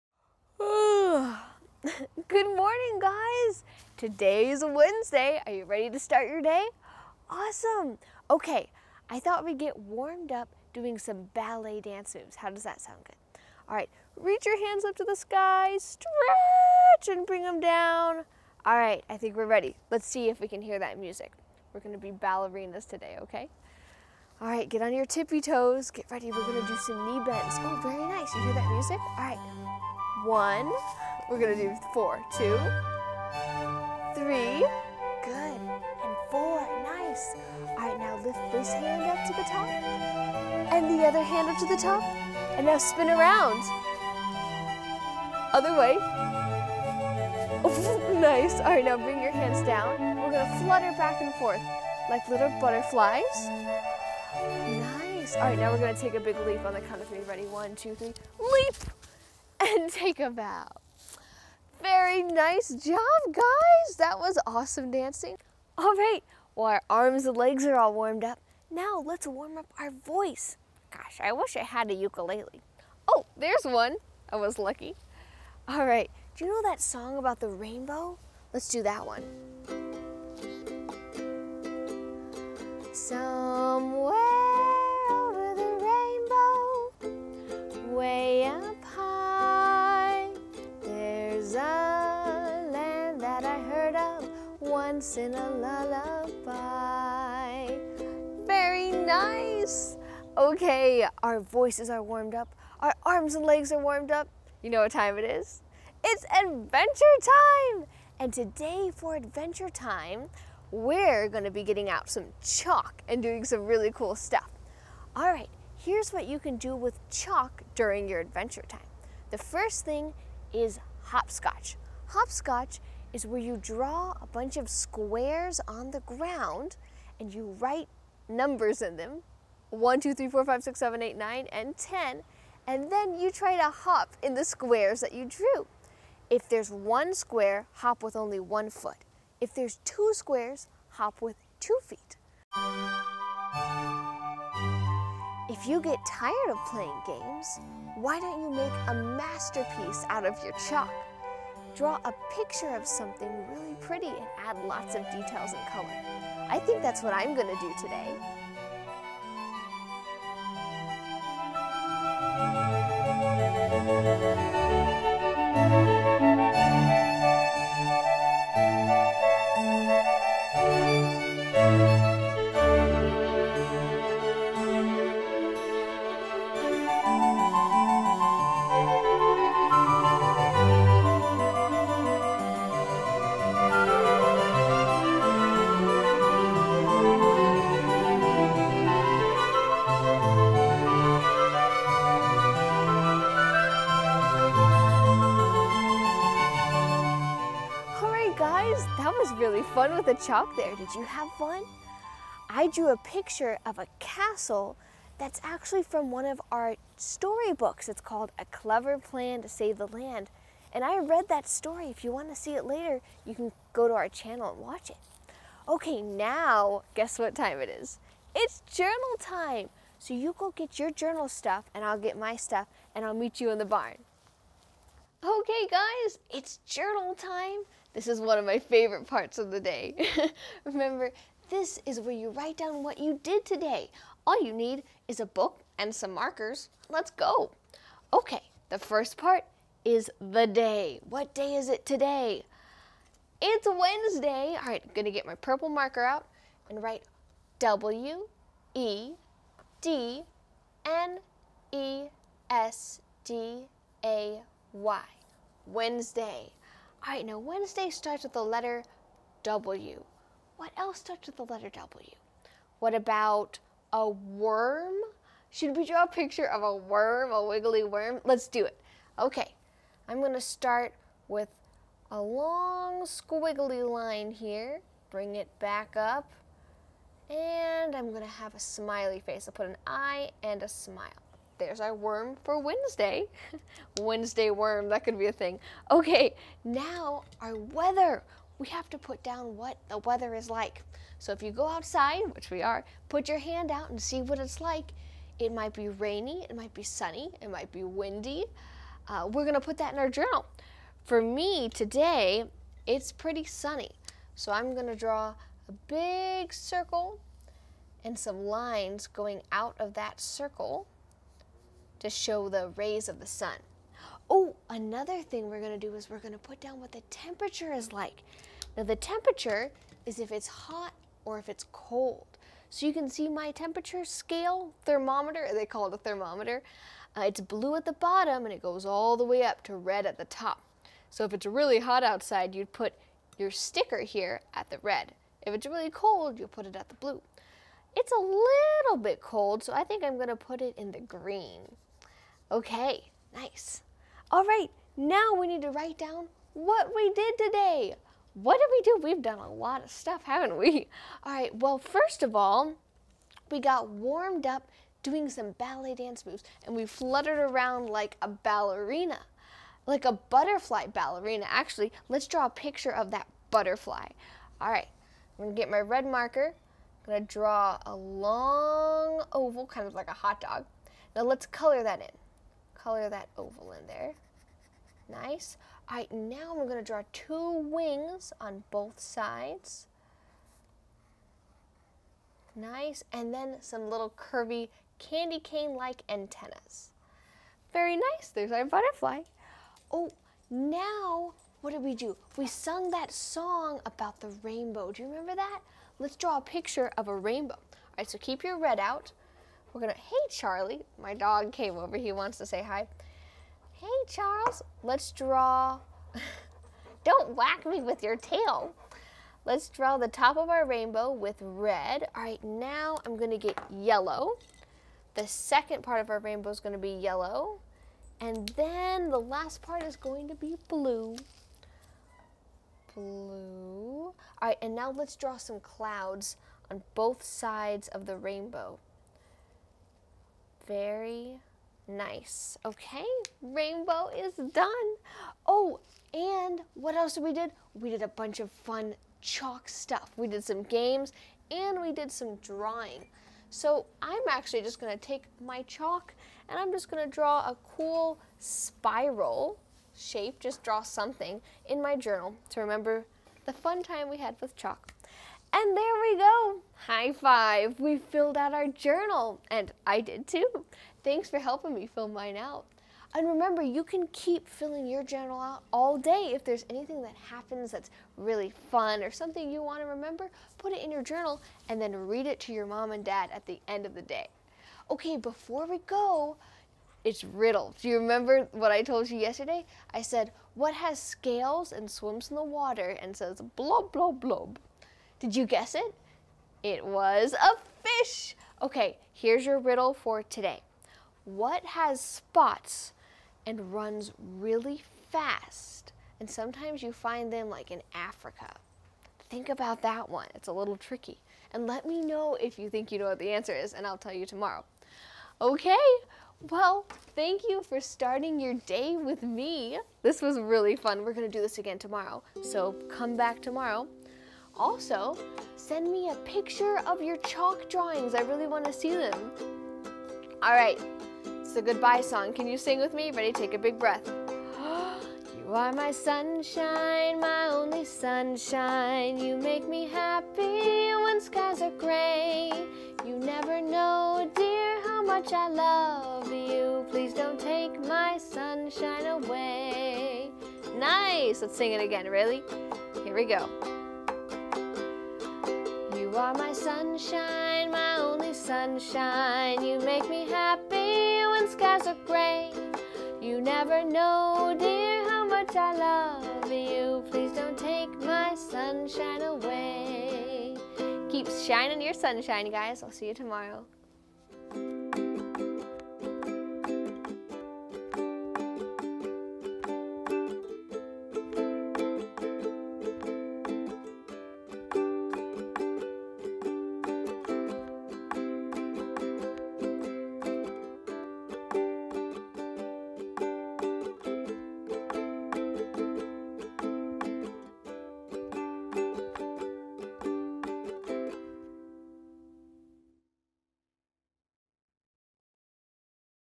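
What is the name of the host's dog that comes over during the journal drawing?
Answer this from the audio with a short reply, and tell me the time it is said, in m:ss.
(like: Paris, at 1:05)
Charlie, at 6:40.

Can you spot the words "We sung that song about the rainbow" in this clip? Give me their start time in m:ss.
6:32.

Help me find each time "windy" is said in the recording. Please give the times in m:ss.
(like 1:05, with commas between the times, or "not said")
4:57.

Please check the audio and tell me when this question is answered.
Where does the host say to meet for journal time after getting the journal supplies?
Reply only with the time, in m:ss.
3:43.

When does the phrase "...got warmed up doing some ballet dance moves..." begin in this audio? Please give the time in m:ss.
5:53.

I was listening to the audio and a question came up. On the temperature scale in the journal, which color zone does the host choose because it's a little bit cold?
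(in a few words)
green.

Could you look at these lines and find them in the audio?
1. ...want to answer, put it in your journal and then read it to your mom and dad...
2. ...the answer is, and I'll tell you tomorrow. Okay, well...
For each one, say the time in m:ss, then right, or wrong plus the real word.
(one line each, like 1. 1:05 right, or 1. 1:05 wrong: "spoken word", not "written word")
1. 7:49 wrong: "remember", not "answer"
2. 8:23 right.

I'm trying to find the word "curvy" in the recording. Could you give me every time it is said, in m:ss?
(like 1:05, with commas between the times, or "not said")
6:24.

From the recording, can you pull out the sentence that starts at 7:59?
I said, what has scales and swims in the water and says blob, blob, blob?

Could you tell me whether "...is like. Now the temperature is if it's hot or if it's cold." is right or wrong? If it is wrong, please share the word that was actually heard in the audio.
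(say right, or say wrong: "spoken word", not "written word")
right.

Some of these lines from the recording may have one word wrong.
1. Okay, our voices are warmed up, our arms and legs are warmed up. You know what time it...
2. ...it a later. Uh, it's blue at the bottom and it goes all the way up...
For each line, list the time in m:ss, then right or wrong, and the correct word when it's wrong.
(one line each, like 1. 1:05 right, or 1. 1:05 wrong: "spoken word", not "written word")
1. 1:40 right
2. 5:25 wrong: "thermometer", not "later".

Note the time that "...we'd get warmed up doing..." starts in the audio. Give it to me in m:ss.
0:09.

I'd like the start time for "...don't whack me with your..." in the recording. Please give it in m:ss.
6:47.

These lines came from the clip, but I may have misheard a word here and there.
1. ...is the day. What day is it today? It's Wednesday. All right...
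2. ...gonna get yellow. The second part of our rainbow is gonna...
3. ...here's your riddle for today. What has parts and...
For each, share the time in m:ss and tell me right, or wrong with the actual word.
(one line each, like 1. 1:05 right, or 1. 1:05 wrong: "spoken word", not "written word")
1. 3:59 right
2. 6:53 right
3. 8:09 wrong: "spots", not "parts".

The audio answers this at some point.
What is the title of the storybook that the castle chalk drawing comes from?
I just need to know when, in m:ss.
3:28.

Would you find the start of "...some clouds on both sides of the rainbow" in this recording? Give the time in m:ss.
7:05.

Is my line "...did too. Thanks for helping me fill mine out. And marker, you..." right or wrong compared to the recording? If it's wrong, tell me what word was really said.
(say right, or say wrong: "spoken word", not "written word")
wrong: "remember", not "marker".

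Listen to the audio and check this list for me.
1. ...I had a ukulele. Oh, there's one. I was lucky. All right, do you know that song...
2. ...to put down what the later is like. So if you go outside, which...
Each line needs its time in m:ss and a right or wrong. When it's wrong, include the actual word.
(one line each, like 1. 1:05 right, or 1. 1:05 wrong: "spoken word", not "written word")
1. 1:11 right
2. 4:48 wrong: "weather", not "later".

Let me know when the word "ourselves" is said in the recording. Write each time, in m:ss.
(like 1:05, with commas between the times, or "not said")
not said.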